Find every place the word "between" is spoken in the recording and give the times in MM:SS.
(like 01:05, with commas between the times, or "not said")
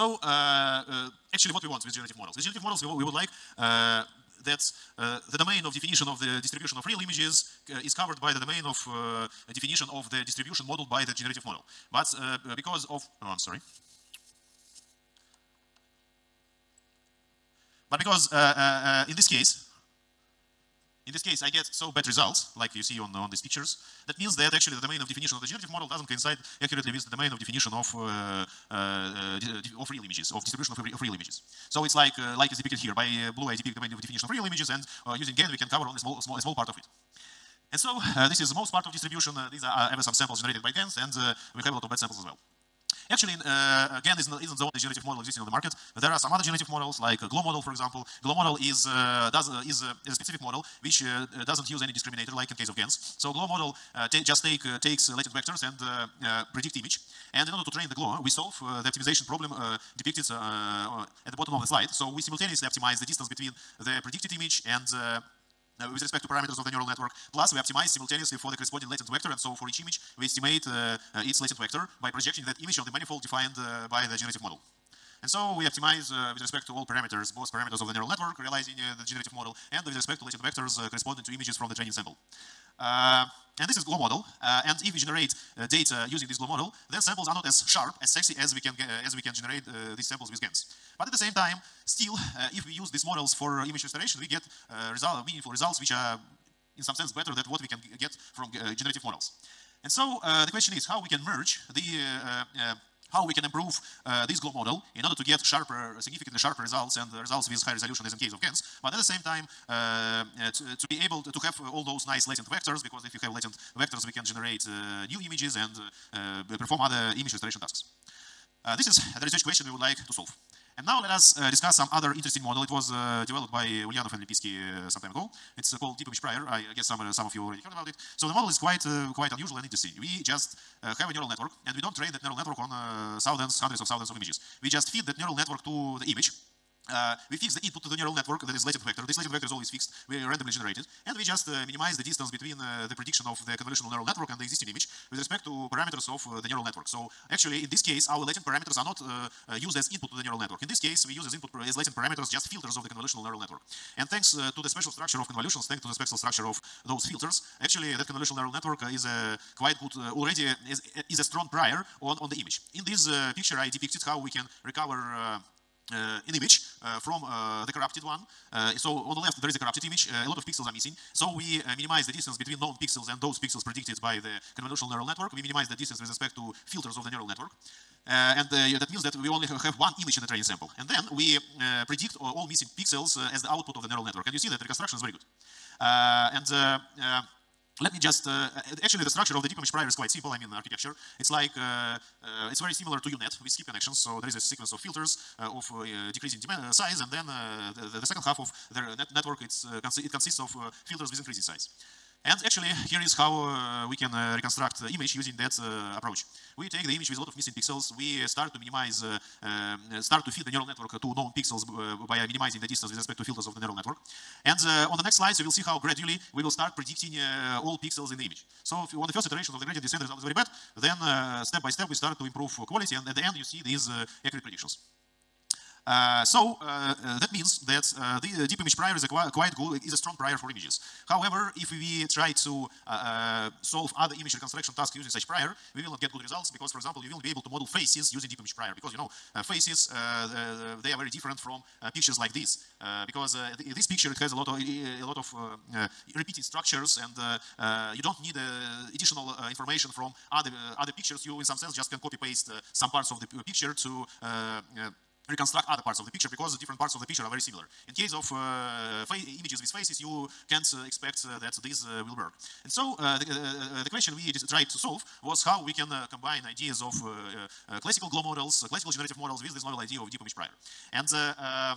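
01:03, 02:22, 02:52.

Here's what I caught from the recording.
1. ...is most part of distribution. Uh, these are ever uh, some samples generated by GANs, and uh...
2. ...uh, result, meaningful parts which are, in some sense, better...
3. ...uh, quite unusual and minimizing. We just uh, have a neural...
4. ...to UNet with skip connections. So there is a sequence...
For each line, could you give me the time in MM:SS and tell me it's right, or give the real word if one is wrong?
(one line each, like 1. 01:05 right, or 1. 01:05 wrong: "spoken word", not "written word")
1. 00:38 right
2. 01:34 wrong: "results", not "parts"
3. 02:08 wrong: "interesting", not "minimizing"
4. 03:12 right.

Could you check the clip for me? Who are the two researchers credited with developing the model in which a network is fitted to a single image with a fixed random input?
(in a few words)
Ulyanov and Lempitsky.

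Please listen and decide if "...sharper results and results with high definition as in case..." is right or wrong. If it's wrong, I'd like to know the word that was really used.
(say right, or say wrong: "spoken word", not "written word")
wrong: "resolution", not "definition".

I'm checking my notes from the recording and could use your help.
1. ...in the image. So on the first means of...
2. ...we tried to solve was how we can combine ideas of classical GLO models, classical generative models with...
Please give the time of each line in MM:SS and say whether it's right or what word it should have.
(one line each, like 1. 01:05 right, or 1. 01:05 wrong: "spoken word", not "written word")
1. 03:38 wrong: "iterations", not "means"
2. 04:24 right.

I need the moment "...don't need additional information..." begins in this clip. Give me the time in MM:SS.
04:08.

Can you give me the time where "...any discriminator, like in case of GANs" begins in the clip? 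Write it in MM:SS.
00:51.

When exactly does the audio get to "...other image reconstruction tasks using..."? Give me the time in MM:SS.
03:53.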